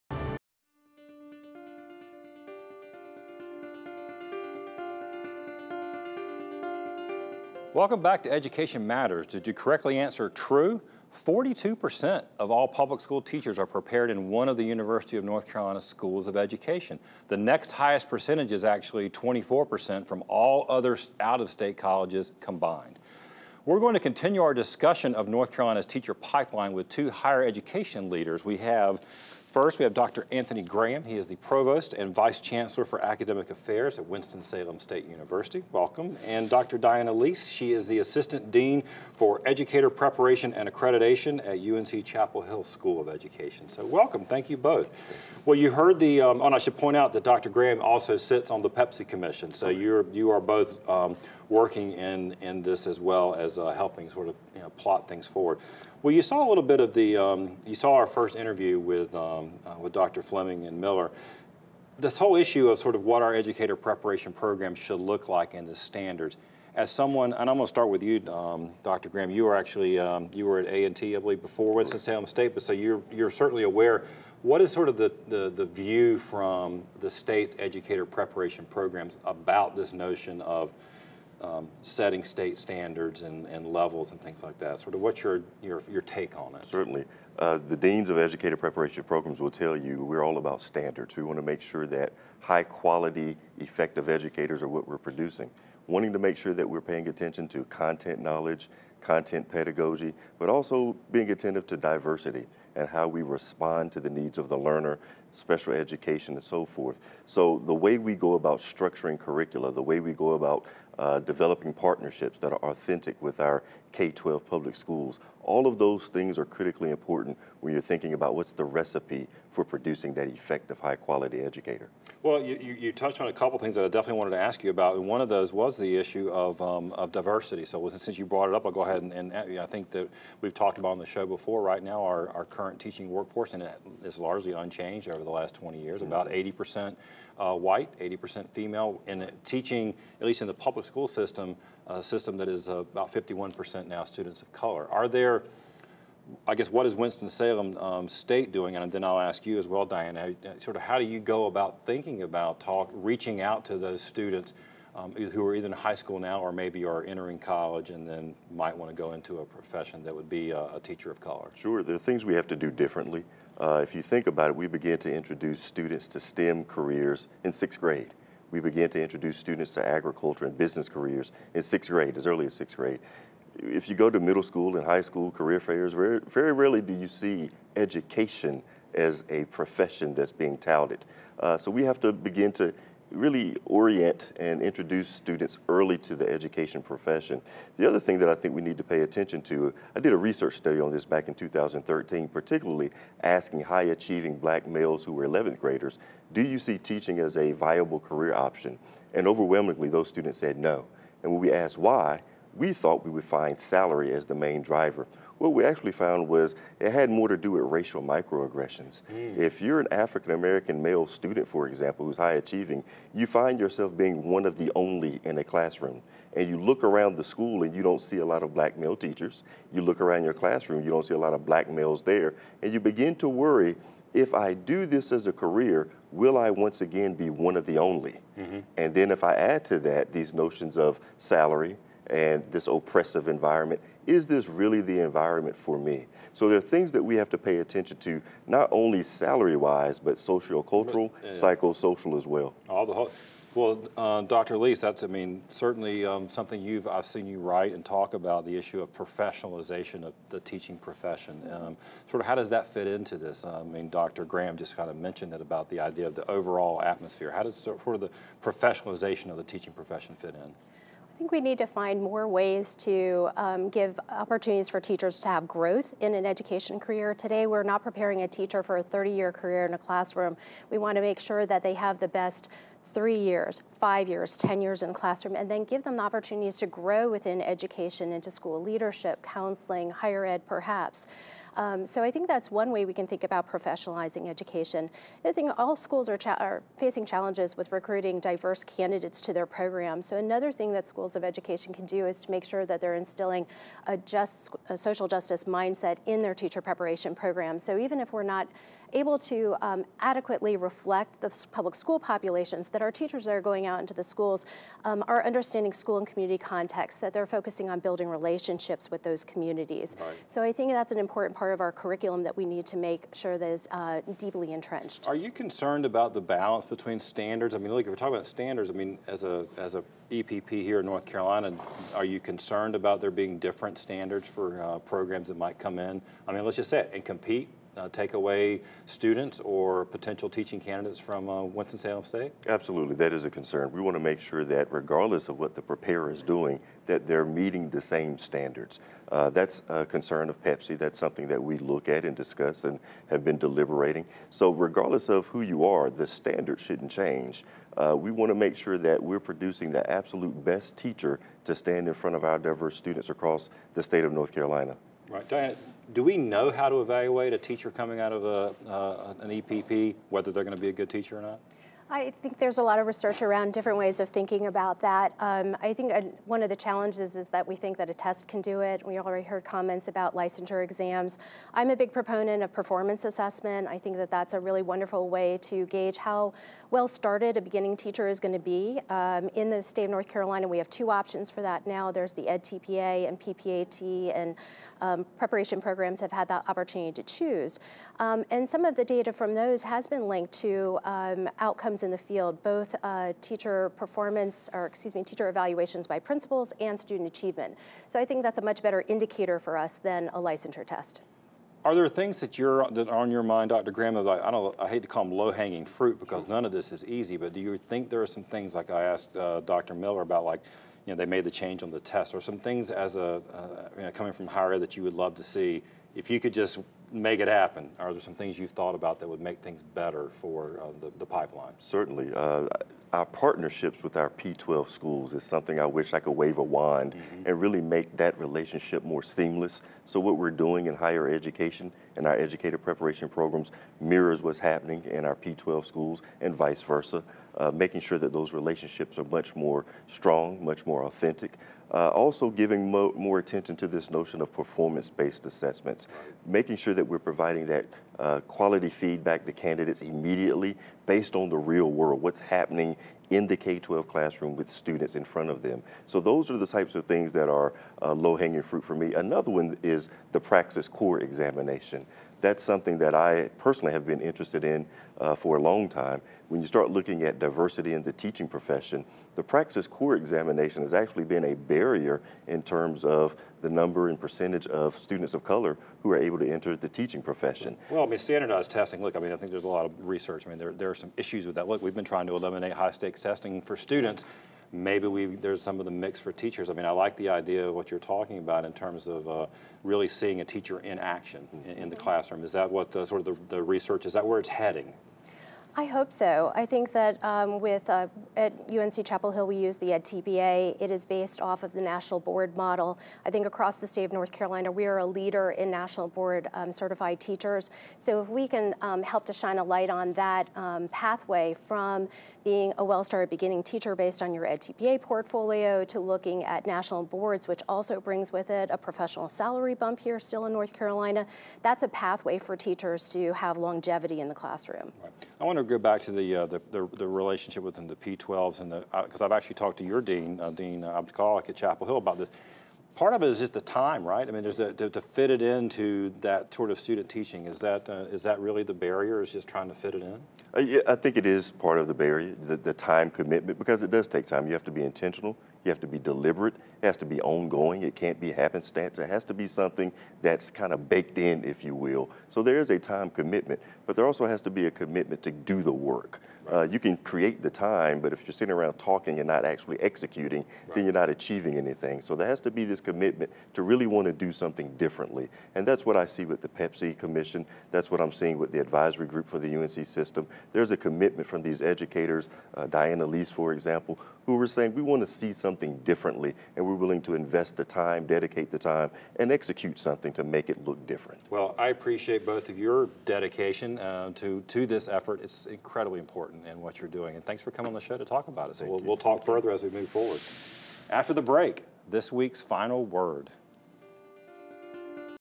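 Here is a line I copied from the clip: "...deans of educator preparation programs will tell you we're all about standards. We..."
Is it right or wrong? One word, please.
right.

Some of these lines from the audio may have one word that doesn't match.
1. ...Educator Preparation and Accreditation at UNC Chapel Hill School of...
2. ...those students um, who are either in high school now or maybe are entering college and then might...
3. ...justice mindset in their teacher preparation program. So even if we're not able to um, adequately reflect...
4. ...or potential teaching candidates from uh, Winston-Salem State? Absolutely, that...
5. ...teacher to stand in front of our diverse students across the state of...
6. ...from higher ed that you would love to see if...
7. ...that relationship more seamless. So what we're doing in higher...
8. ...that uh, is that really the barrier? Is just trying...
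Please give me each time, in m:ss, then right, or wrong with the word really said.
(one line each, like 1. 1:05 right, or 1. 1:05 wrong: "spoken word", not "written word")
1. 0:39 right
2. 2:33 right
3. 4:55 right
4. 5:29 right
5. 5:50 right
6. 6:54 right
7. 7:07 right
8. 8:57 right.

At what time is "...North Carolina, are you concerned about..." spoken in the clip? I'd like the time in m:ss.
5:20.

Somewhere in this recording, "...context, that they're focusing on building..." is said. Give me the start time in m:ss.
5:06.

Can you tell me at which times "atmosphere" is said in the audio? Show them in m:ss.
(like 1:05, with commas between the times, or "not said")
4:16.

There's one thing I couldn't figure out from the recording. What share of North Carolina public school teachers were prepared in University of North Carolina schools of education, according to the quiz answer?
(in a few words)
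42%.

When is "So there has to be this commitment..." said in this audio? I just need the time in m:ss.
9:21.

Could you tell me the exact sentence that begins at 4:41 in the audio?
Um, so I think that's one way we can think about professionalizing education.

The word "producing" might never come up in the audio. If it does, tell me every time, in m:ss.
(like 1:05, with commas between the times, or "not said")
1:34, 1:59, 5:49.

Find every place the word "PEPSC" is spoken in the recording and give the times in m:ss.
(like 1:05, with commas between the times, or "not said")
0:48, 5:40, 9:26.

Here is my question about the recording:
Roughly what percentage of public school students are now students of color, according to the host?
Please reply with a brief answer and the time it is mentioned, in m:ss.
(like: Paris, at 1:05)
51%, at 2:23.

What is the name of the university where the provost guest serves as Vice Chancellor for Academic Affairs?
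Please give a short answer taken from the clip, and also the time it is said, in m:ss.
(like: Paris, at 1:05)
Winston-Salem State University, at 0:34.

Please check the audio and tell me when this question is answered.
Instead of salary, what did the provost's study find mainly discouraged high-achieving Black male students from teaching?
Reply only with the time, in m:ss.
3:27.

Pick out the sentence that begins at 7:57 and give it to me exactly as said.
Well, I mean, standardized testing, look, I mean, I think there's a lot of research.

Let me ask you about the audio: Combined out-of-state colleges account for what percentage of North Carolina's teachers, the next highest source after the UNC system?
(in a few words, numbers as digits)
24%.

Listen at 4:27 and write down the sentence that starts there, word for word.
Today, we're not preparing a teacher for a 30-year career in a classroom.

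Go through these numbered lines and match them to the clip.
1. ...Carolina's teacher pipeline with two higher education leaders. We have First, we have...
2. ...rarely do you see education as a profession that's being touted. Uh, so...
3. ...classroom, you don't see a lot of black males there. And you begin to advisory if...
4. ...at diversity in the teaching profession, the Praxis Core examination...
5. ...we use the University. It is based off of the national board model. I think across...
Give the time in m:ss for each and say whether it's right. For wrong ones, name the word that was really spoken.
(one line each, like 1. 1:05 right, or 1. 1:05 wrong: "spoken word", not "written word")
1. 0:25 right
2. 2:56 right
3. 3:40 wrong: "worry", not "advisory"
4. 7:47 right
5. 8:19 wrong: "EdTPA", not "University".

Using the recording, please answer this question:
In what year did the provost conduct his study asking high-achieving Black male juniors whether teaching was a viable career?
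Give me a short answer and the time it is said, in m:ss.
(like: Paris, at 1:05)
2013, at 3:11.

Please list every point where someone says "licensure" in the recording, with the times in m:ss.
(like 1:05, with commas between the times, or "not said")
6:10, 6:40.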